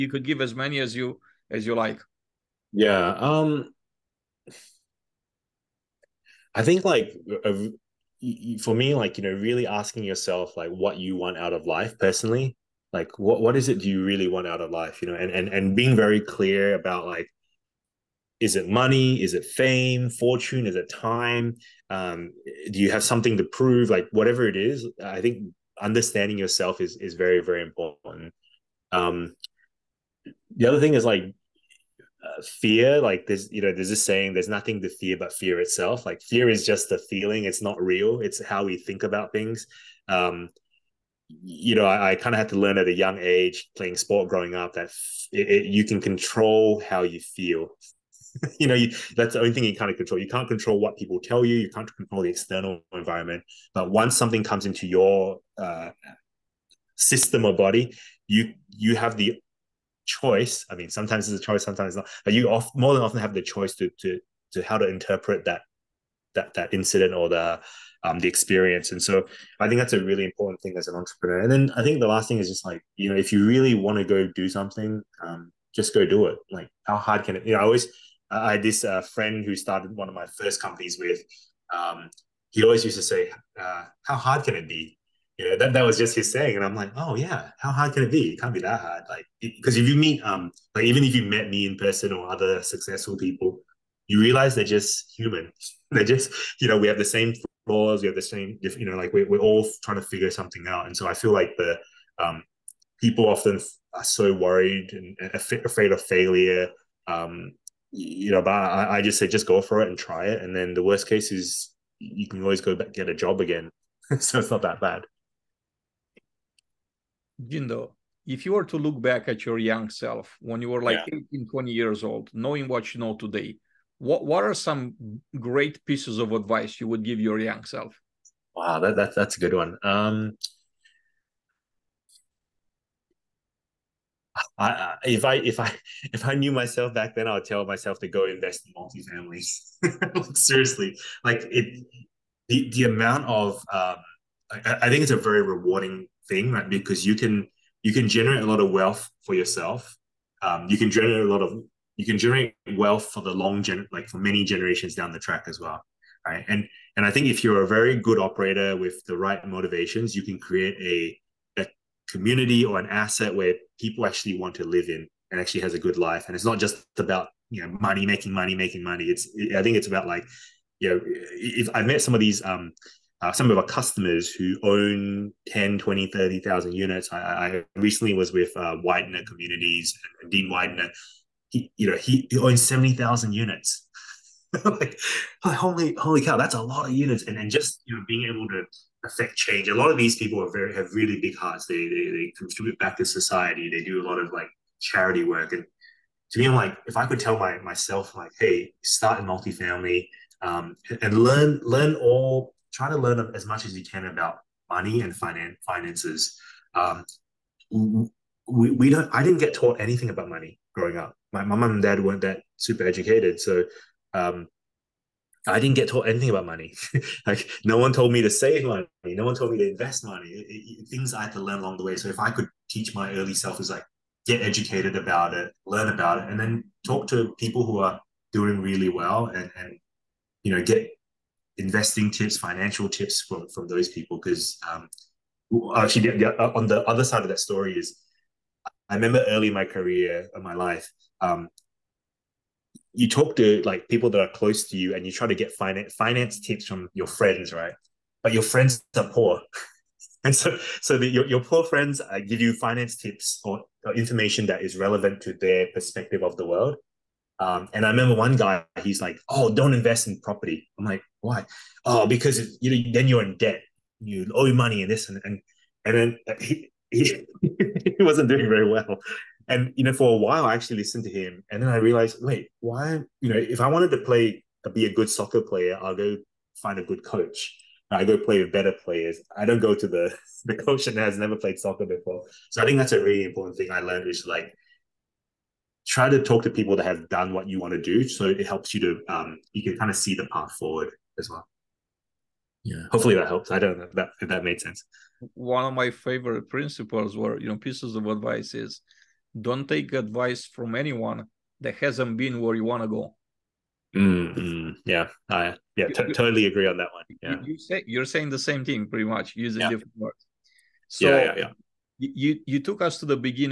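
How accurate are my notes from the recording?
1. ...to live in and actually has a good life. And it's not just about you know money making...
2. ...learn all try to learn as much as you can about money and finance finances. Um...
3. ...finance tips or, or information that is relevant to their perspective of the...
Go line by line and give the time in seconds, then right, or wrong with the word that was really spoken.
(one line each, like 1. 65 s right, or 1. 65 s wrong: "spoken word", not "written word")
1. 164 s right
2. 201 s right
3. 252 s right.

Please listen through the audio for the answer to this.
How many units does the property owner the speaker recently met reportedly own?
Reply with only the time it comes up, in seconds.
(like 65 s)
182 s.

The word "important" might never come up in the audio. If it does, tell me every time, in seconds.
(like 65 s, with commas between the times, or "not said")
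27 s, 70 s, 283 s.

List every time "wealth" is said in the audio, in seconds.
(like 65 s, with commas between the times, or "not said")
148 s, 152 s.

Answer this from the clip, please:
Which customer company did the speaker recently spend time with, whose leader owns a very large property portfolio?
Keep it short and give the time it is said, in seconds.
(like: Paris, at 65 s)
Weidner Communities, at 178 s.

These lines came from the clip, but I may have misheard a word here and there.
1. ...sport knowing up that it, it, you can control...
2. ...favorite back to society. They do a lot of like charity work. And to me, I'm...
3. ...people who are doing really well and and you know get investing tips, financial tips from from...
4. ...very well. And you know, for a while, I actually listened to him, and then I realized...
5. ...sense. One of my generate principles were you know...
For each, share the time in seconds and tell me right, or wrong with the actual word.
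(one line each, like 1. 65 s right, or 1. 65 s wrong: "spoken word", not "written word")
1. 43 s wrong: "growing", not "knowing"
2. 192 s wrong: "contribute", not "favorite"
3. 227 s right
4. 268 s right
5. 294 s wrong: "favorite", not "generate".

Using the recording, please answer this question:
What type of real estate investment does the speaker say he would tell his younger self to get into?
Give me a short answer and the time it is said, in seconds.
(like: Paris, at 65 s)
Multifamilies, at 138 s.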